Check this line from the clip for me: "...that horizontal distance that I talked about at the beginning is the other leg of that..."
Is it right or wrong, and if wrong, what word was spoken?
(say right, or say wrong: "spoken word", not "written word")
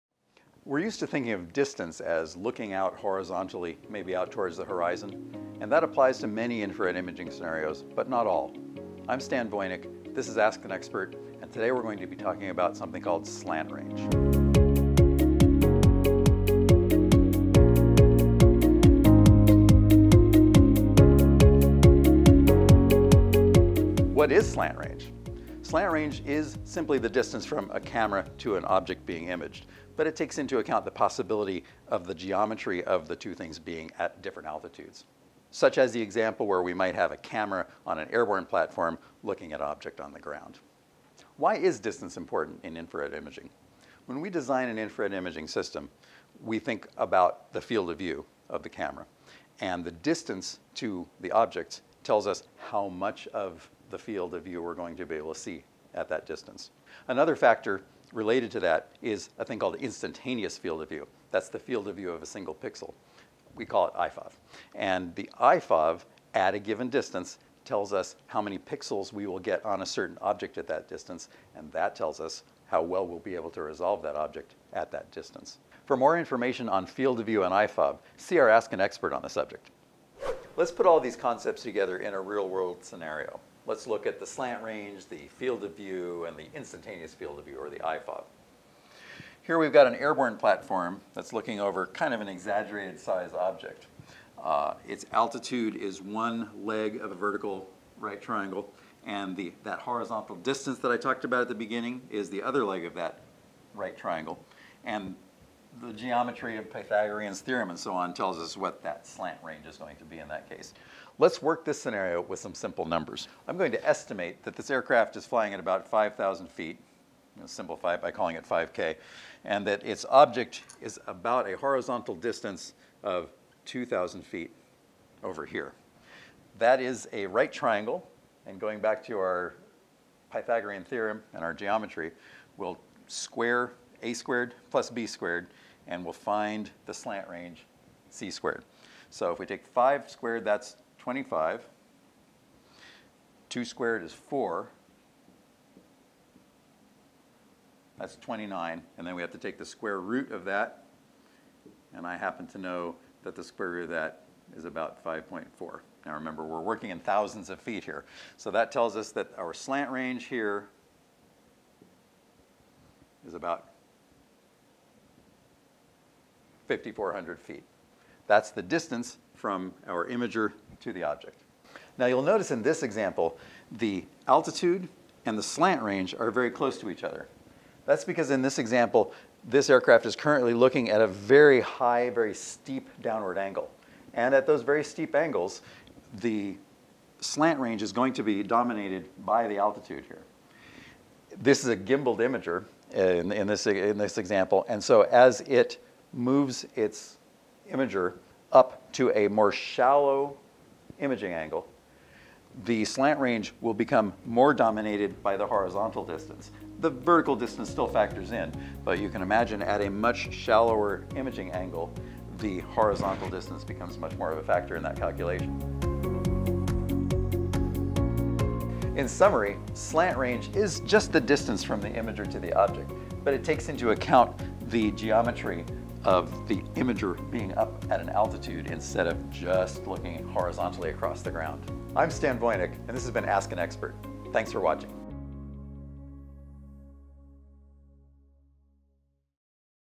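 right.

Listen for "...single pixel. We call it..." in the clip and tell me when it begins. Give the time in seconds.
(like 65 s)
62 s.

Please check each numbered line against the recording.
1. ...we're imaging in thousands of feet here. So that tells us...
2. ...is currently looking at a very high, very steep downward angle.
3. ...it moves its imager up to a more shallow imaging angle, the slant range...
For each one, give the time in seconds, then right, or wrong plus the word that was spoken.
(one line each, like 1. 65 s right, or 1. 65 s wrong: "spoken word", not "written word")
1. 156 s wrong: "working", not "imaging"
2. 180 s right
3. 195 s right.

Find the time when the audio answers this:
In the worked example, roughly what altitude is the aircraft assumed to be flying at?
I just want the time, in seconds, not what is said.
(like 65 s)
115 s.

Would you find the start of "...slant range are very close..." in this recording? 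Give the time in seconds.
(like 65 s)
175 s.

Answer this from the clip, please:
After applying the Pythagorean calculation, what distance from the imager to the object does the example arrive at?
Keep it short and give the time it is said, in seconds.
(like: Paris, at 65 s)
5,400 feet, at 166 s.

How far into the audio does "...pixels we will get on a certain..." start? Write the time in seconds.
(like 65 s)
68 s.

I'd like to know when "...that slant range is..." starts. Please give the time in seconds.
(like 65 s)
108 s.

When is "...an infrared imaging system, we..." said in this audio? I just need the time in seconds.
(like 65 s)
44 s.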